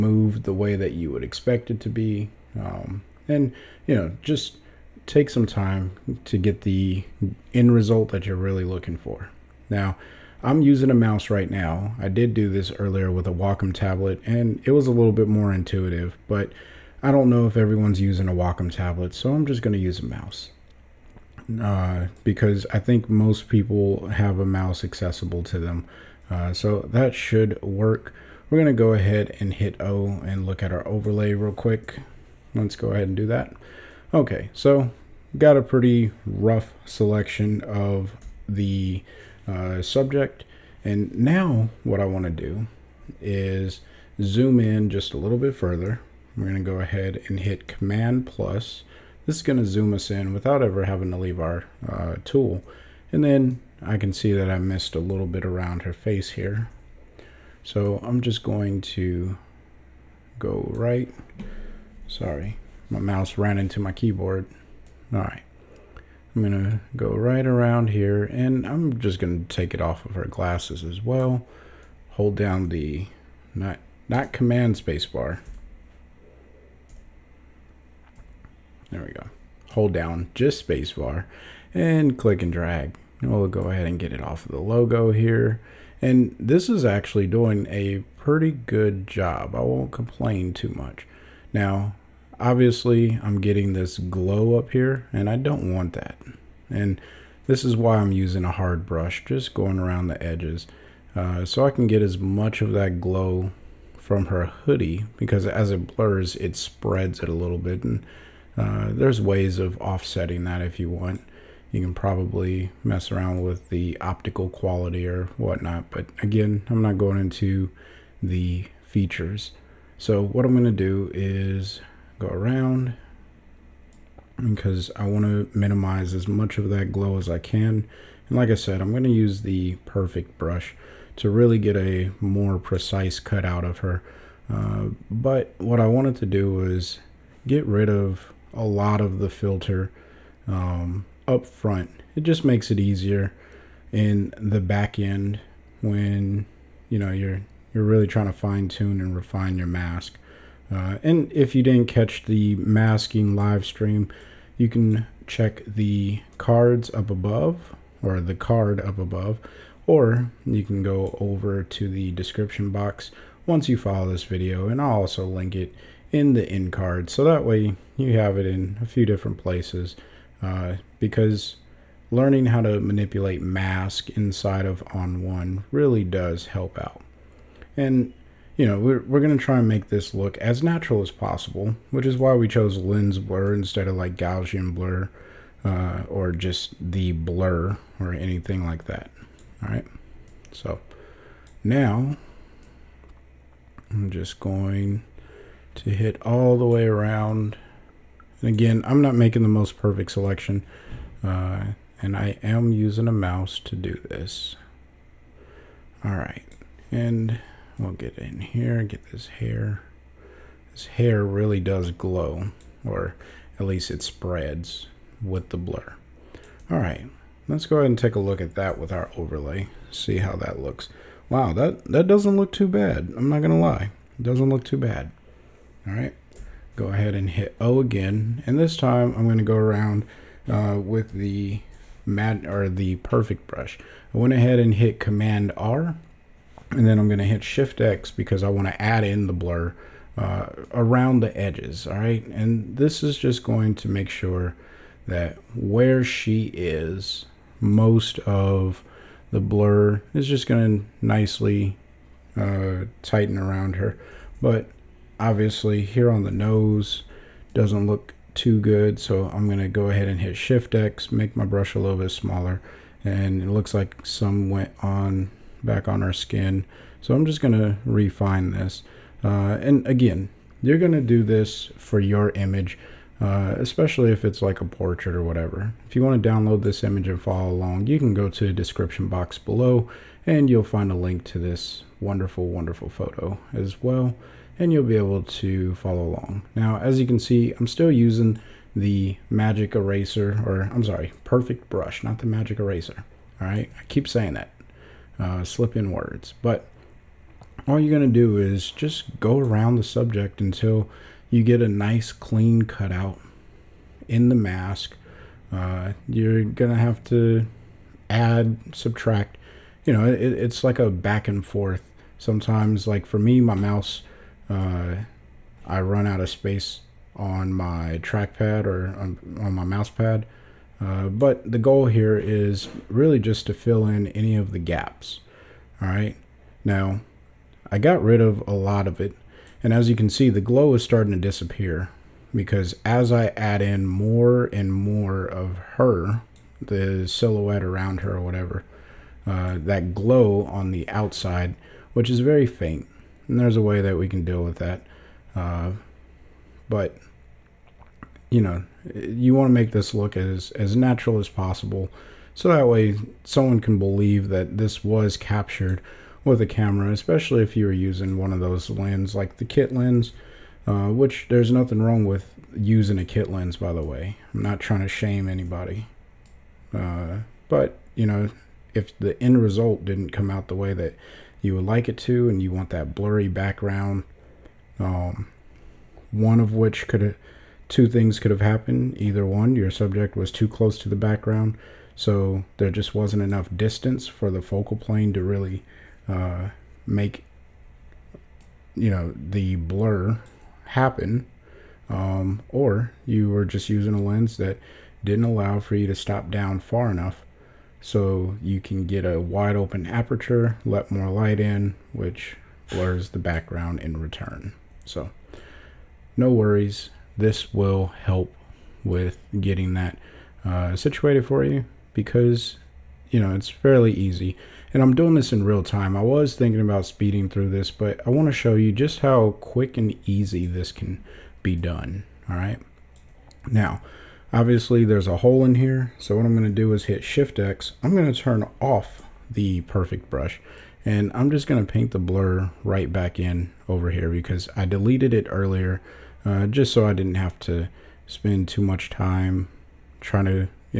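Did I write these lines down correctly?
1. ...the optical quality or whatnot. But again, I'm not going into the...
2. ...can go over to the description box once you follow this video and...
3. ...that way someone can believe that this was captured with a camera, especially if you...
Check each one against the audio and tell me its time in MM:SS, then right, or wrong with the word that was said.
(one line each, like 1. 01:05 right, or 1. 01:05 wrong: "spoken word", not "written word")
1. 01:53 right
2. 02:40 right
3. 05:52 right.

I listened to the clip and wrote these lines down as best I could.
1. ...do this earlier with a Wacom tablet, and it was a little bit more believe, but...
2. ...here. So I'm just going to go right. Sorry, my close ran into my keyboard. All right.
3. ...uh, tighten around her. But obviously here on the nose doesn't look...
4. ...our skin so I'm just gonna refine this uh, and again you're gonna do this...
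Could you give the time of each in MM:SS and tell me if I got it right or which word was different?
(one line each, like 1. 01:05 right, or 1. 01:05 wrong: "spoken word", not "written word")
1. 00:12 wrong: "intuitive", not "believe"
2. 00:56 wrong: "mouse", not "close"
3. 04:12 right
4. 04:26 right.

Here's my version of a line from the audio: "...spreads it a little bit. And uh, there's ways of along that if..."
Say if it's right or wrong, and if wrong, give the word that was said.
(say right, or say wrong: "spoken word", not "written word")
wrong: "offsetting", not "along".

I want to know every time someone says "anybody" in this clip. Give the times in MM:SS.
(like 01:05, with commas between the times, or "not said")
06:05.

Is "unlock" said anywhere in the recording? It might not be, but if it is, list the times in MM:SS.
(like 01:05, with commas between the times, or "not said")
not said.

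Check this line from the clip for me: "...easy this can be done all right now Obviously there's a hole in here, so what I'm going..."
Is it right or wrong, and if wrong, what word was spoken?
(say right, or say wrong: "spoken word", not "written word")
right.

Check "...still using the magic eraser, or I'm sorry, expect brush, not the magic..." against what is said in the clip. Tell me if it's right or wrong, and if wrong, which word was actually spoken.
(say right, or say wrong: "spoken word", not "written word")
wrong: "perfect", not "expect".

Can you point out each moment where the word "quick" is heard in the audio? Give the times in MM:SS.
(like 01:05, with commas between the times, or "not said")
00:31, 06:59.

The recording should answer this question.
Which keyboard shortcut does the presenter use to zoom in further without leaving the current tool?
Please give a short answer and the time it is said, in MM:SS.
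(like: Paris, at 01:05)
Command plus, at 00:47.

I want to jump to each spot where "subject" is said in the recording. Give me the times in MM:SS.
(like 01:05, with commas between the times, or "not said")
00:39, 04:59, 06:19.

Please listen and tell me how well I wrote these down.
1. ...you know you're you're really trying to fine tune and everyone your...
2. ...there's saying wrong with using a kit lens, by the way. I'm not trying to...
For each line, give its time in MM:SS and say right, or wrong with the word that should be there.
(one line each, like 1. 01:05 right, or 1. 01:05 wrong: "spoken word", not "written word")
1. 02:26 wrong: "refine", not "everyone"
2. 06:01 wrong: "nothing", not "saying".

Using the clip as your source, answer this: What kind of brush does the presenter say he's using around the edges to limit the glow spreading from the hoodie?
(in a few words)
hard brush.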